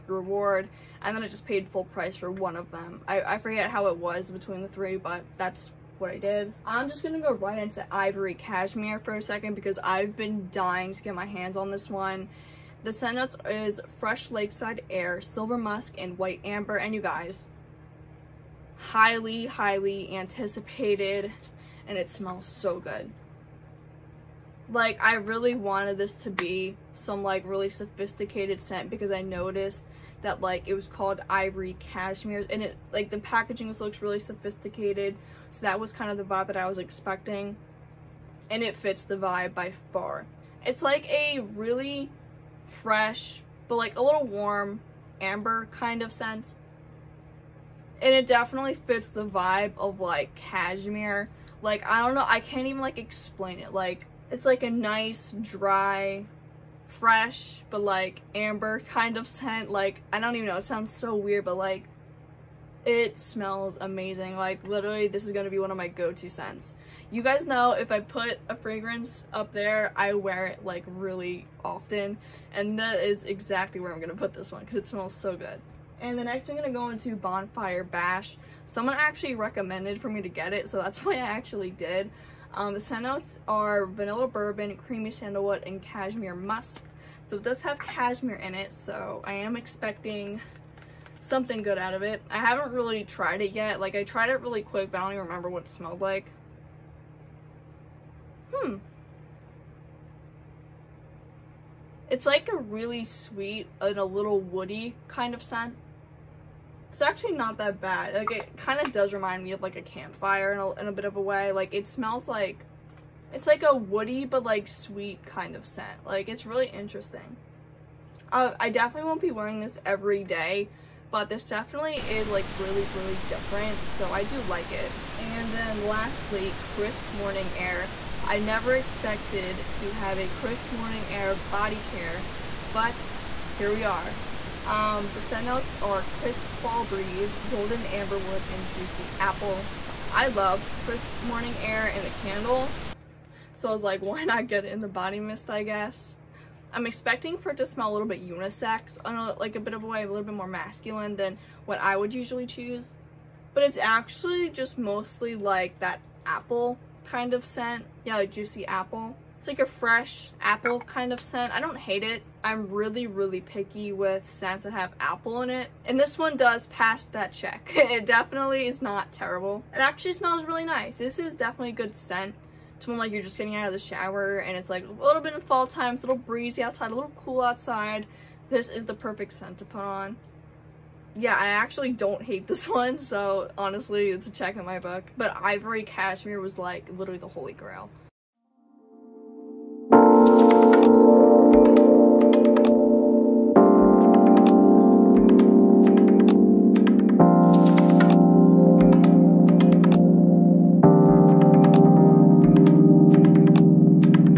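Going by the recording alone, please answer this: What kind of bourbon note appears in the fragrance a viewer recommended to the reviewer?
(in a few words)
Vanilla bourbon.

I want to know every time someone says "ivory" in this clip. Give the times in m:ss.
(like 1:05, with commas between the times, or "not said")
0:07, 0:31, 3:05.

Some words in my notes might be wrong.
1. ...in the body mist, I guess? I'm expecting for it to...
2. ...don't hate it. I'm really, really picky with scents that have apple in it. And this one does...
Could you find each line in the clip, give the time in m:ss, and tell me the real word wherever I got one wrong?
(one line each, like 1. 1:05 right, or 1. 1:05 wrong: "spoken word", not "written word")
1. 2:24 right
2. 2:41 right.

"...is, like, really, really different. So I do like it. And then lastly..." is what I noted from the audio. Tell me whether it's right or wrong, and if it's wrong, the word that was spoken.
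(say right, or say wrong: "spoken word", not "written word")
right.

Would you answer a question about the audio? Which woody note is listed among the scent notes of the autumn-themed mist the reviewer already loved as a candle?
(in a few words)
Golden amberwood.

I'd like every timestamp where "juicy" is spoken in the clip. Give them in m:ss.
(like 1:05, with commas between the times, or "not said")
2:18, 2:38.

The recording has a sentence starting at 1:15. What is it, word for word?
And the next I'm gonna go into Bonfire Bash.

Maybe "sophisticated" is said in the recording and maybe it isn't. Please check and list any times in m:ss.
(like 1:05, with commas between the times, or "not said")
0:27, 0:34.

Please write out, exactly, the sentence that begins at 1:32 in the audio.
I haven't really tried it yet.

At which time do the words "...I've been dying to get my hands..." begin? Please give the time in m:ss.
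0:09.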